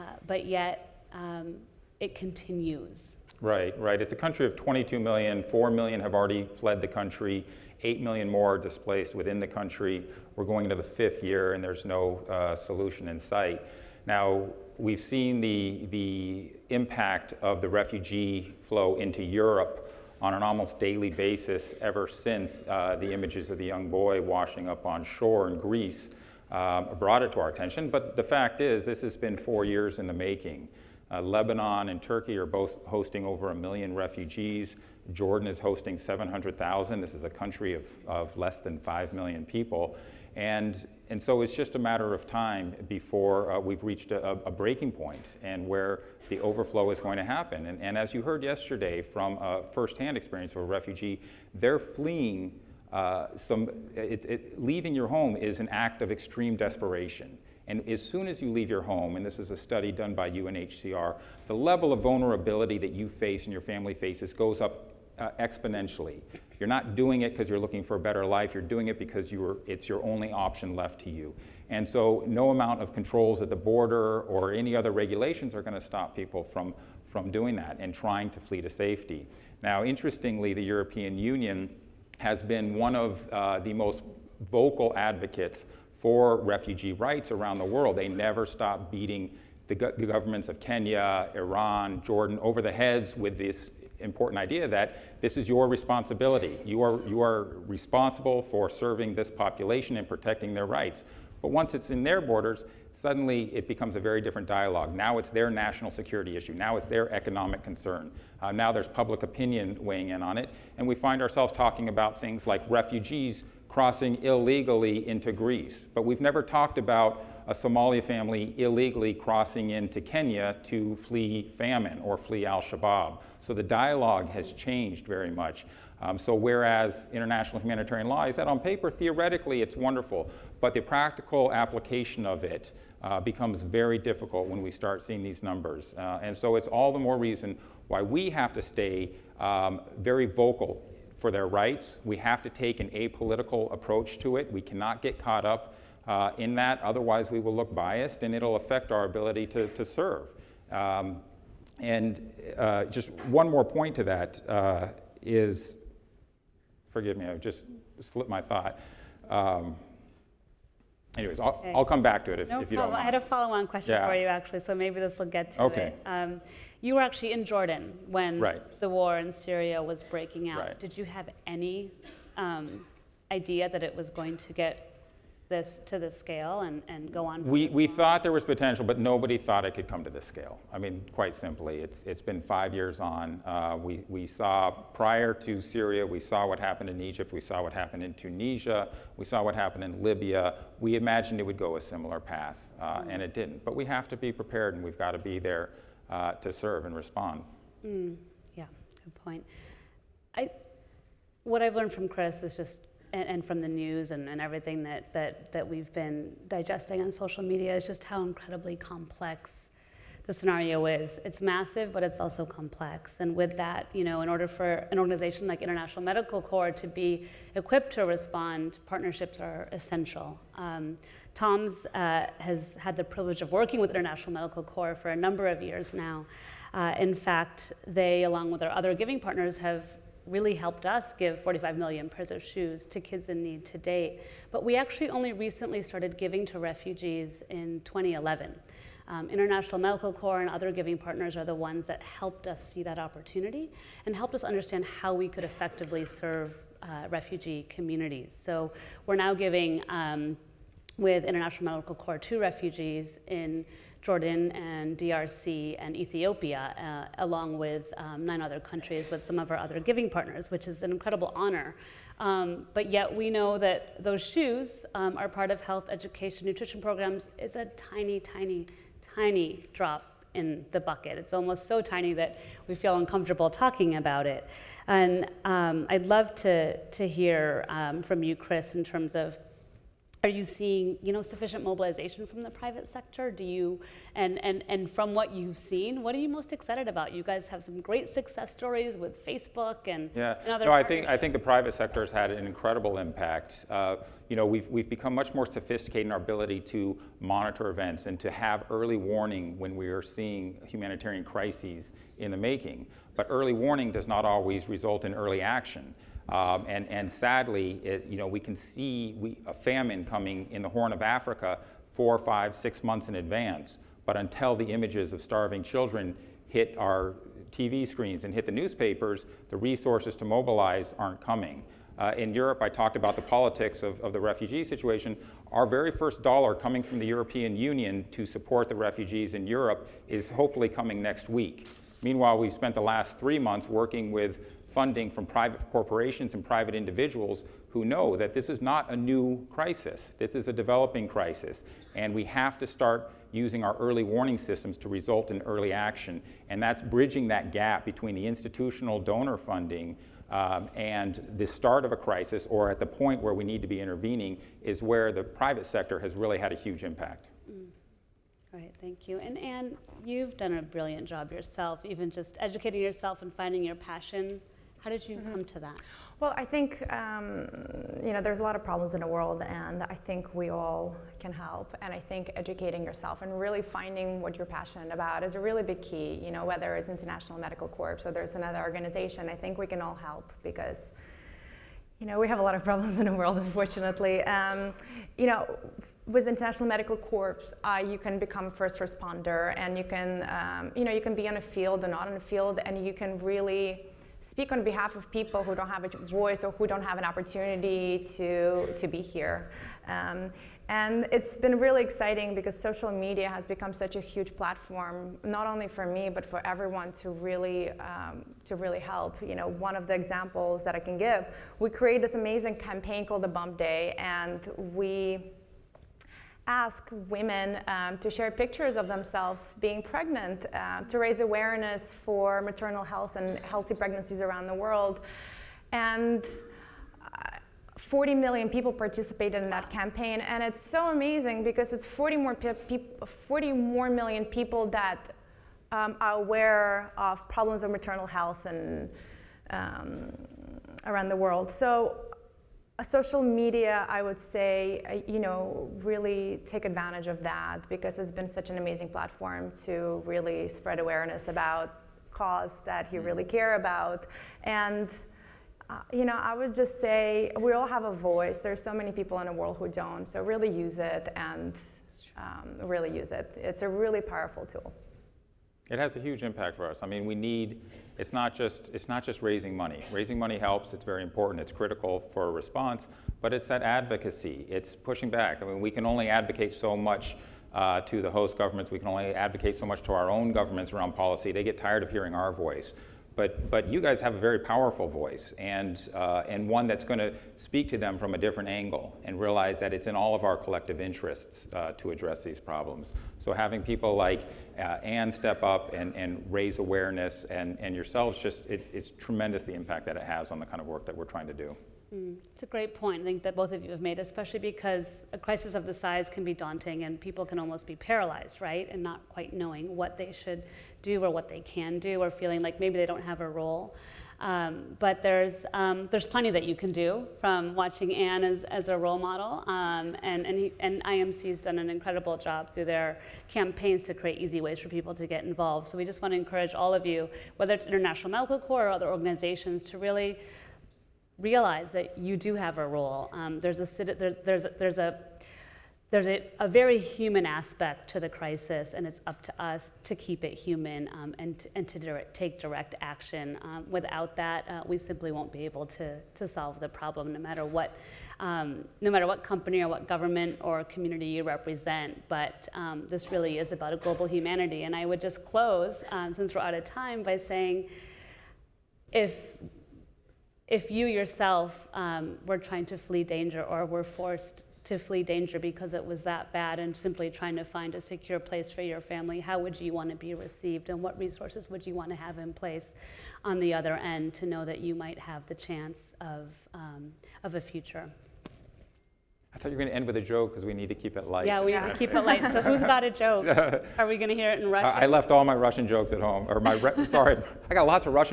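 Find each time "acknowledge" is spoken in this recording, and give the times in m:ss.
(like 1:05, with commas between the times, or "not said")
not said.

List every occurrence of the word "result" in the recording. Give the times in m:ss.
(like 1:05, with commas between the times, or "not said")
5:04, 5:44.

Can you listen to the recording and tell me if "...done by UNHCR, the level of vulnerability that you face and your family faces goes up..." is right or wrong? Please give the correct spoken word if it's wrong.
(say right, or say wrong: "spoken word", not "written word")
right.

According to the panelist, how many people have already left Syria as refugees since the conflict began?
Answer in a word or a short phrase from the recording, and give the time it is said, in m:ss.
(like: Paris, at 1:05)
4 million, at 0:05.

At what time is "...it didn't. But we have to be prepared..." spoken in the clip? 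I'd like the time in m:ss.
3:13.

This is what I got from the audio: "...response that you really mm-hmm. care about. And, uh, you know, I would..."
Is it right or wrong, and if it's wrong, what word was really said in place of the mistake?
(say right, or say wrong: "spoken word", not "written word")
wrong: "cause", not "response".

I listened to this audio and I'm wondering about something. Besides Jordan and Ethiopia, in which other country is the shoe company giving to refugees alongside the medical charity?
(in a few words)
DRC.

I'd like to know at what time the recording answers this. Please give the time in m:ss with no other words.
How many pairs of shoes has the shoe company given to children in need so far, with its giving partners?
3:51.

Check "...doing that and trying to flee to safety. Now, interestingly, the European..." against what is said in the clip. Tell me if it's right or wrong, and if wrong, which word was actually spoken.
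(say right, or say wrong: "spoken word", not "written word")
right.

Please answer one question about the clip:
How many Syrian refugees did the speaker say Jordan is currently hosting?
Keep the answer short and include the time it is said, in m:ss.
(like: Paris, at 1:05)
700,000, at 0:35.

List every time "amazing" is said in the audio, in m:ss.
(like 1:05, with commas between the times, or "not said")
6:52, 7:10, 7:28.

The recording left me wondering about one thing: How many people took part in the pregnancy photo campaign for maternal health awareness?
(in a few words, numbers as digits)
40 million.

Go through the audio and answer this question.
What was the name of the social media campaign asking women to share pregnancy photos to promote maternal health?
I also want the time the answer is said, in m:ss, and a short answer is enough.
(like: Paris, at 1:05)
Bump Day, at 6:53.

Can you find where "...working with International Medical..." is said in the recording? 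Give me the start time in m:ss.
3:43.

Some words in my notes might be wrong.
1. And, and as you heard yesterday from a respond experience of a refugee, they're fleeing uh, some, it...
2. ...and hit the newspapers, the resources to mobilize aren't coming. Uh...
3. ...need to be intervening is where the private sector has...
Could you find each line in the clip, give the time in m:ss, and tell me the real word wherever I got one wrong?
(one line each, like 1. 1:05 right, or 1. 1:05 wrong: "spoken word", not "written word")
1. 0:47 wrong: "firsthand", not "respond"
2. 5:18 right
3. 5:53 right.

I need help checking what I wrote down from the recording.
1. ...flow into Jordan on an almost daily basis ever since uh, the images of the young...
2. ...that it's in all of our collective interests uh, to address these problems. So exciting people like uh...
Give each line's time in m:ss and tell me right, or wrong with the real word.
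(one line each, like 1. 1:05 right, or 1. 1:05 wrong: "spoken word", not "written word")
1. 0:18 wrong: "Europe", not "Jordan"
2. 8:09 wrong: "having", not "exciting".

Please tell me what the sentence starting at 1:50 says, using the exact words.
And we find ourselves talking about things like refugees crossing illegally into Greece.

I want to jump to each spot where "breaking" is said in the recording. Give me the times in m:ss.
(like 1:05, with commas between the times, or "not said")
0:44, 2:50.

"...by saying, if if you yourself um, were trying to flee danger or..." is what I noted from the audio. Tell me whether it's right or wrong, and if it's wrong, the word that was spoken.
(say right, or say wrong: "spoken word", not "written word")
right.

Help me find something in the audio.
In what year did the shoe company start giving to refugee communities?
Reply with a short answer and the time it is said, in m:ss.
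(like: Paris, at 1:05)
2011, at 3:57.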